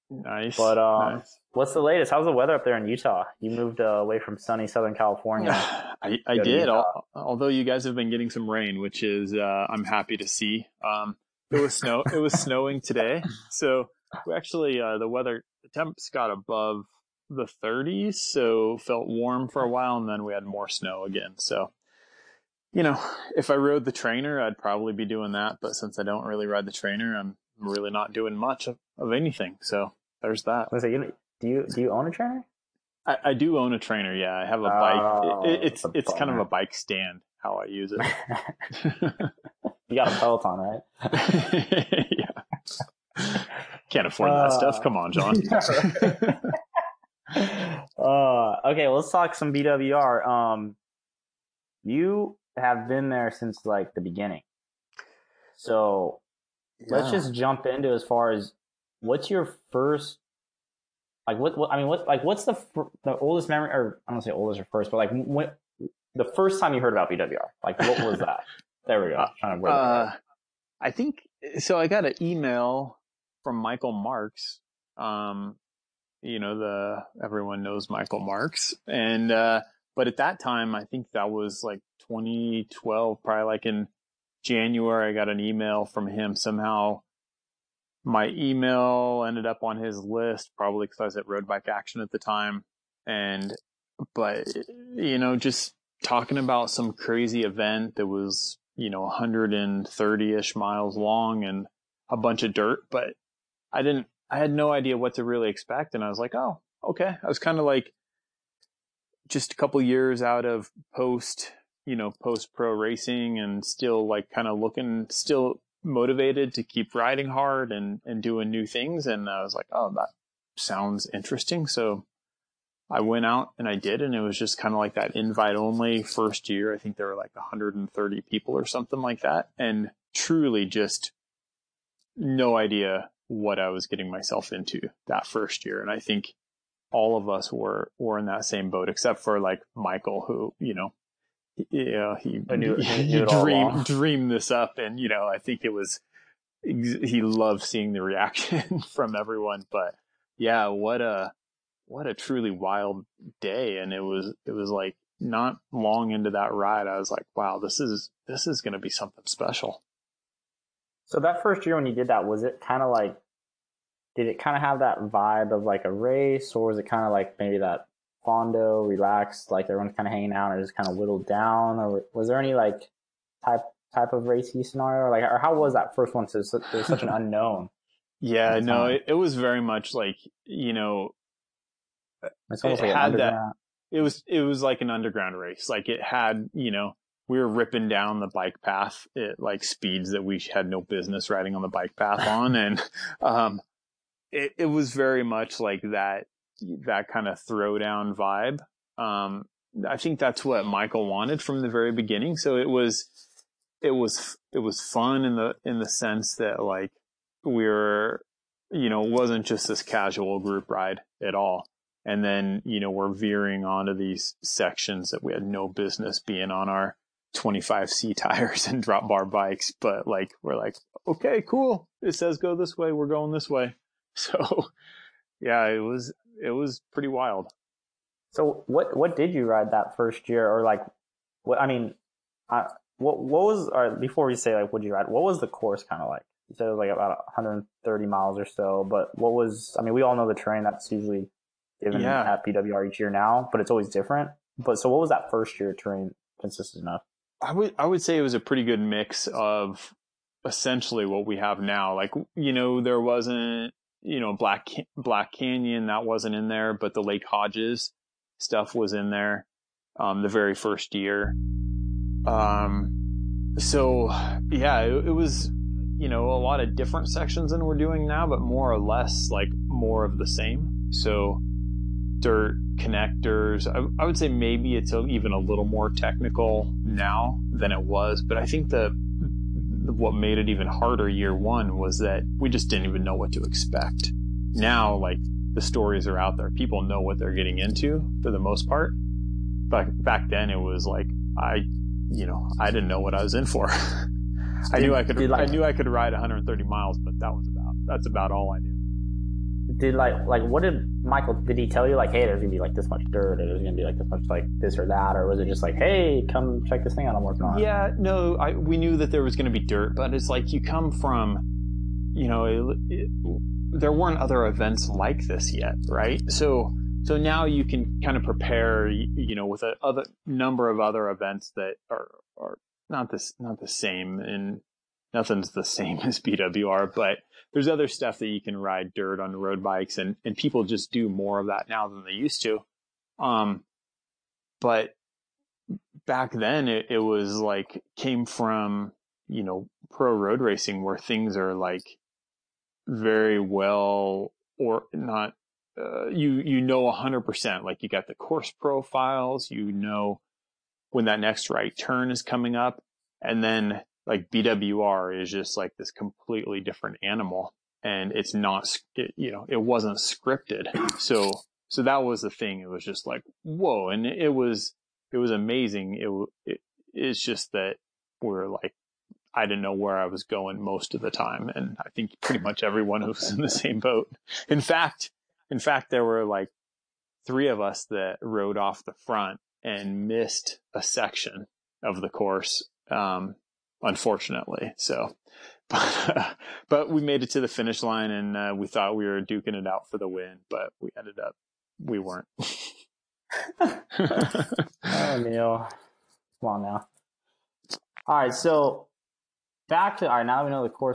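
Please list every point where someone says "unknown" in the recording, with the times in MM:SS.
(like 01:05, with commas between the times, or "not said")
02:57.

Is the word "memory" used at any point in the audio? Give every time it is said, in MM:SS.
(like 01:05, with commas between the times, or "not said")
01:03.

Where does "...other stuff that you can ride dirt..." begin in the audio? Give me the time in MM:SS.
05:27.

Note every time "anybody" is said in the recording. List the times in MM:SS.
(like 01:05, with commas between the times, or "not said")
not said.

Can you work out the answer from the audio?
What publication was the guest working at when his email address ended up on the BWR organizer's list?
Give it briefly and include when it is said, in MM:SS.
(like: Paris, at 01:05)
Road Bike Action, at 01:31.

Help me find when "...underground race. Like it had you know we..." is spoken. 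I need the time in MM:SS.
03:04.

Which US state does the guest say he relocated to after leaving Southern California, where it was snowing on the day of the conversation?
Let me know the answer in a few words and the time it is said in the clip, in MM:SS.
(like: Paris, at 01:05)
Utah, at 00:02.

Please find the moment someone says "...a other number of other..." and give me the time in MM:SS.
05:19.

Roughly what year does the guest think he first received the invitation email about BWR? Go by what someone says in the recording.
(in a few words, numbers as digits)
2012.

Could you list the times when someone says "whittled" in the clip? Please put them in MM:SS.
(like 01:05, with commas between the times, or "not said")
02:50.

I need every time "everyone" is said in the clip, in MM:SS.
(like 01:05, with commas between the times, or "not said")
01:17, 02:29, 02:49, 06:12.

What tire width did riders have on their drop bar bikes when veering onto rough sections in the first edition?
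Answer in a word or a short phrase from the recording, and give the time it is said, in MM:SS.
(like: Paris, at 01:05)
25C, at 03:37.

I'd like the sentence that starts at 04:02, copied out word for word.
at BWR each year now, but it's always different.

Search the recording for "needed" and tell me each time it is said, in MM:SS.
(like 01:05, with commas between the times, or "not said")
not said.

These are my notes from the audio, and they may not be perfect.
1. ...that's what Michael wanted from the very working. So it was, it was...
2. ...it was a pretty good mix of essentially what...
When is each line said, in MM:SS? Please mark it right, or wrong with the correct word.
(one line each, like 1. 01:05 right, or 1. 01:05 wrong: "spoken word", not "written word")
1. 03:20 wrong: "beginning", not "working"
2. 04:08 right.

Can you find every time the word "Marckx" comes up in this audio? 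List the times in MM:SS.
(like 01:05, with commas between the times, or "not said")
01:13, 01:18.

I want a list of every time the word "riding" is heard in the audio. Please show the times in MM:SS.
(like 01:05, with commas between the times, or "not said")
01:56, 03:11.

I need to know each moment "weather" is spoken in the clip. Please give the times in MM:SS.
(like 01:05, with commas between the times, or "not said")
00:02, 00:15.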